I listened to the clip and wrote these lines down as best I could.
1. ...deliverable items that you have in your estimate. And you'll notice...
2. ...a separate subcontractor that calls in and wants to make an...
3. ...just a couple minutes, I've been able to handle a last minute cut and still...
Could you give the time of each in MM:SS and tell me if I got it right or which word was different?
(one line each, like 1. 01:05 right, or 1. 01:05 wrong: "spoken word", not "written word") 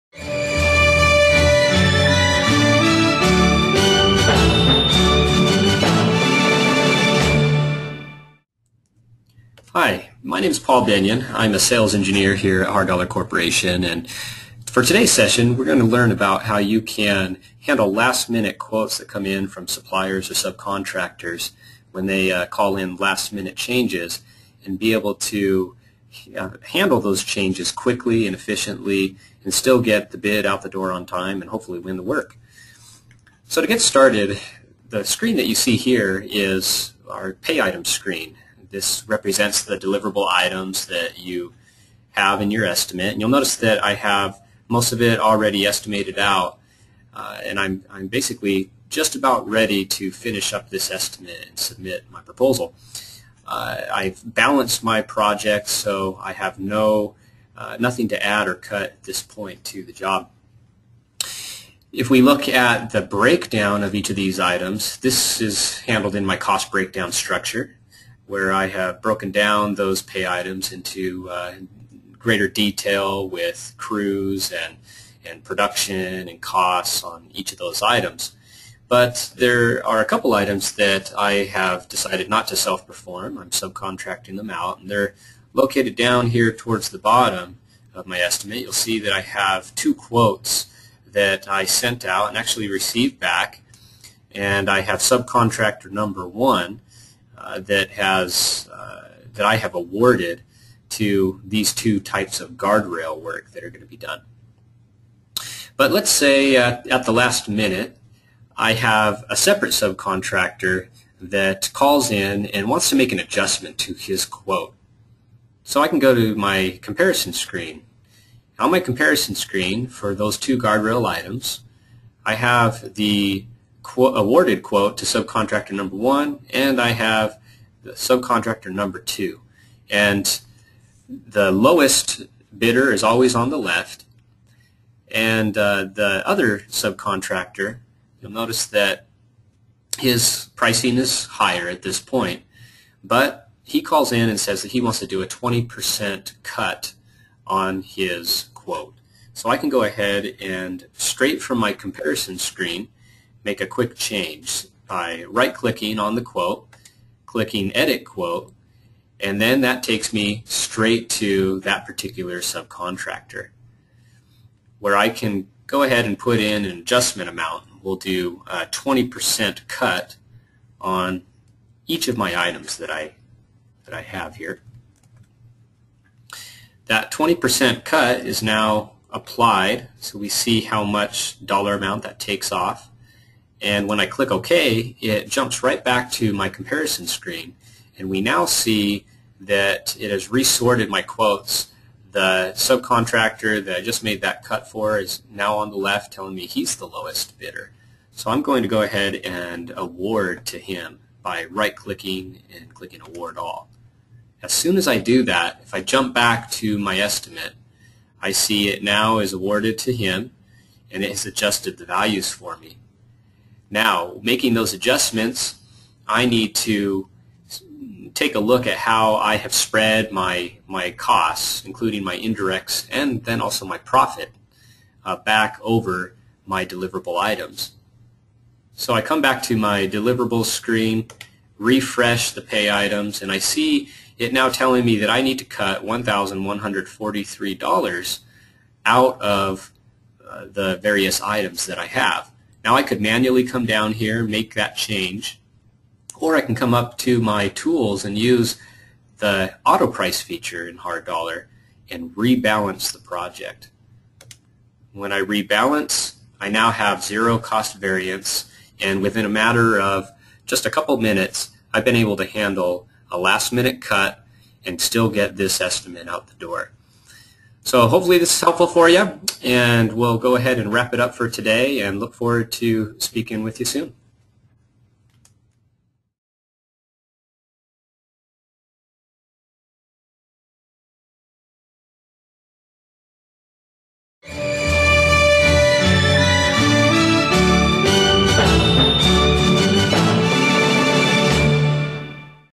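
1. 00:39 right
2. 01:49 right
3. 04:20 right.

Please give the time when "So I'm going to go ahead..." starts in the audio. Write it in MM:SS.
03:18.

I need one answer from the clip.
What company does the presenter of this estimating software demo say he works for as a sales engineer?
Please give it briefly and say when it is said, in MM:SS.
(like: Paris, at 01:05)
Hard Dollar Corporation, at 00:12.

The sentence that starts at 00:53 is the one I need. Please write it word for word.
Uh, I've balanced my project, so I have no uh, nothing to add or cut at this point to the job.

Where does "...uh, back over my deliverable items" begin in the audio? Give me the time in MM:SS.
03:45.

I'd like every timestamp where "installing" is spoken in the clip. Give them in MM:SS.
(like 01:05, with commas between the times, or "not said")
not said.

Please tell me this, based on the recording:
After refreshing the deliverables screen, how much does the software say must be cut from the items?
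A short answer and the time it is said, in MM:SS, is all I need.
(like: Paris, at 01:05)
$1,143, at 03:55.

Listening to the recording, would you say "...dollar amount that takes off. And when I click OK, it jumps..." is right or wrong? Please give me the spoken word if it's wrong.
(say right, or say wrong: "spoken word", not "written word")
right.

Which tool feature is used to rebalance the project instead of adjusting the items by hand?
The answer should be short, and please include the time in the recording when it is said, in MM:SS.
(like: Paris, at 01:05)
auto price, at 04:09.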